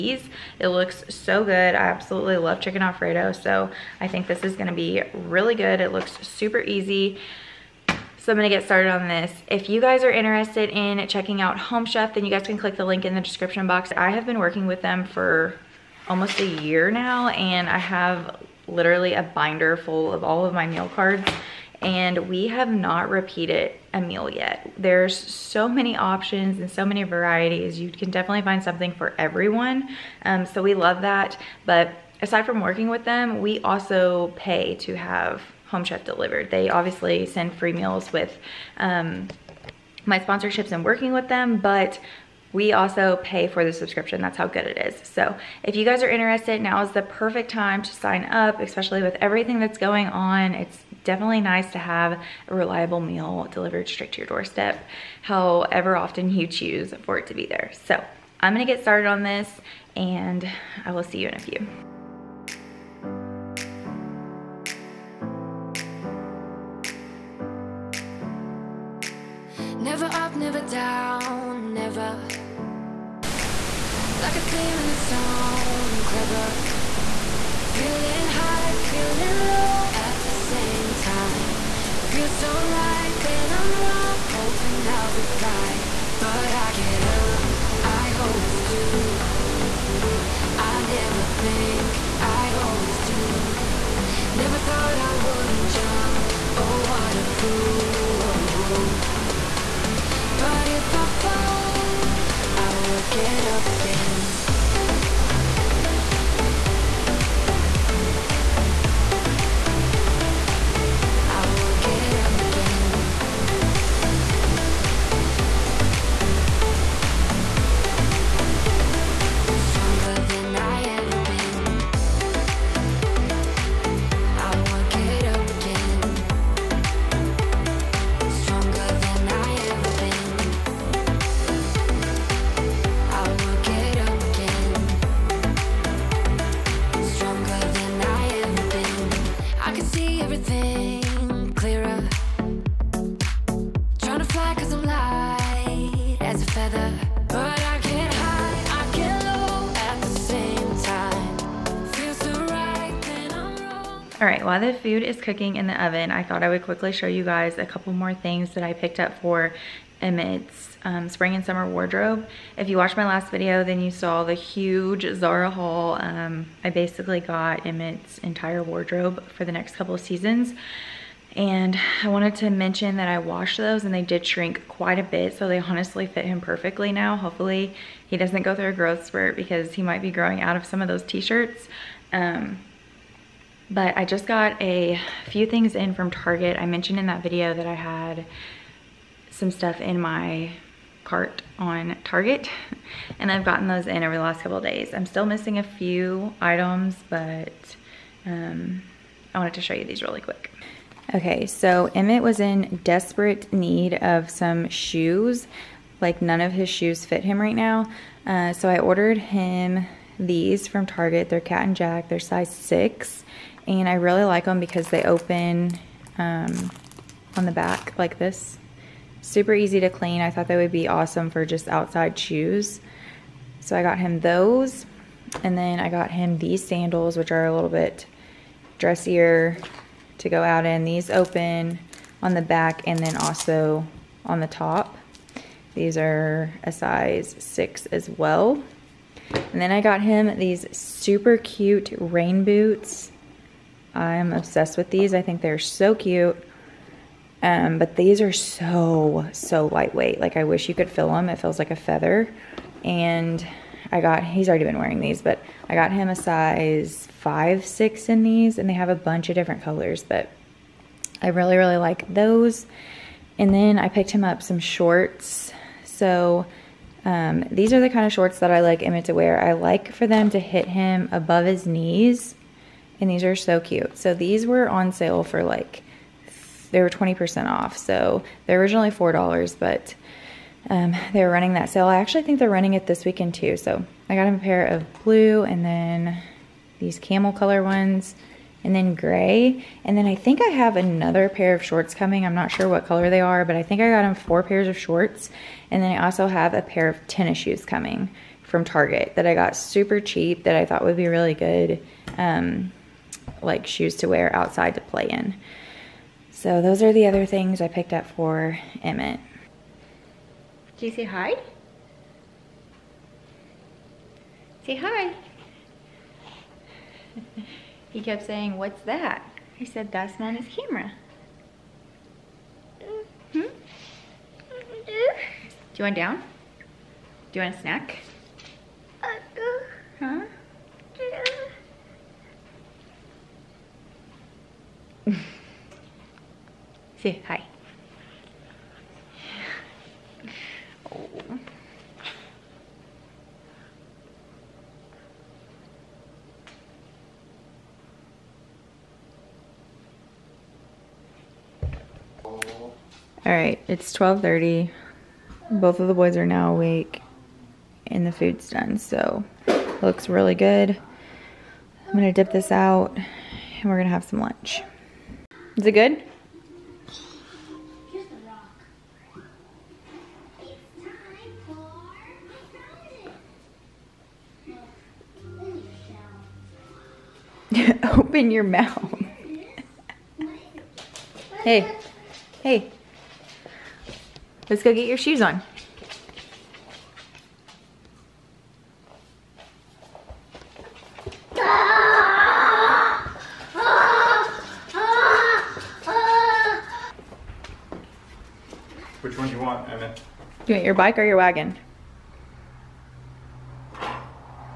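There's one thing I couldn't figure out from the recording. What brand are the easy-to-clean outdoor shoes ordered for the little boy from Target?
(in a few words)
Cat and Jack.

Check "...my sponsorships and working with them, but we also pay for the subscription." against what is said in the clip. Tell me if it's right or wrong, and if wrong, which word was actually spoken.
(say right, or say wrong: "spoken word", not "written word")
right.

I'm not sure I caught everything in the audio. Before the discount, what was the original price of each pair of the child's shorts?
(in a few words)
$4.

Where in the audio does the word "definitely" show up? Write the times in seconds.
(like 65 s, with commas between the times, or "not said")
28 s, 51 s.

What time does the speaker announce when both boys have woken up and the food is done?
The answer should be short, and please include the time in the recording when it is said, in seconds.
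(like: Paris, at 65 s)
12:30, at 353 s.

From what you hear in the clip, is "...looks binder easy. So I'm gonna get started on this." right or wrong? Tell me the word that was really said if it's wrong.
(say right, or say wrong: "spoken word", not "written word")
wrong: "super", not "binder".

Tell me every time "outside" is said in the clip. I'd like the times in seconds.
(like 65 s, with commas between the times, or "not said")
221 s, 304 s.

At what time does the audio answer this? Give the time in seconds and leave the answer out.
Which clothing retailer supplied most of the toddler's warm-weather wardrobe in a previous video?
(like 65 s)
165 s.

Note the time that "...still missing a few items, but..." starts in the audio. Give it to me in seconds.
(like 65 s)
195 s.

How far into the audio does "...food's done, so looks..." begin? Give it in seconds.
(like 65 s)
358 s.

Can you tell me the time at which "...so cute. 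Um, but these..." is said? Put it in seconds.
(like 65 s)
245 s.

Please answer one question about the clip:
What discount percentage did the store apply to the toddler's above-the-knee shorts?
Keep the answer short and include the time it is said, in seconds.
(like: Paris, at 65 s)
20%, at 276 s.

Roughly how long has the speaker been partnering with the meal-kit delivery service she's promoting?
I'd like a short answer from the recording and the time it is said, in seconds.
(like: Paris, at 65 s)
Almost a year, at 16 s.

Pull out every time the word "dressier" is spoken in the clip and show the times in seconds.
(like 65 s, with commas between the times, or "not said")
228 s.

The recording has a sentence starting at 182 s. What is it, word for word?
Um, but I just got a few things in from Target.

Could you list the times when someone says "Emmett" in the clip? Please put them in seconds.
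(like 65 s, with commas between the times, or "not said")
160 s, 167 s, 201 s, 268 s, 308 s, 399 s.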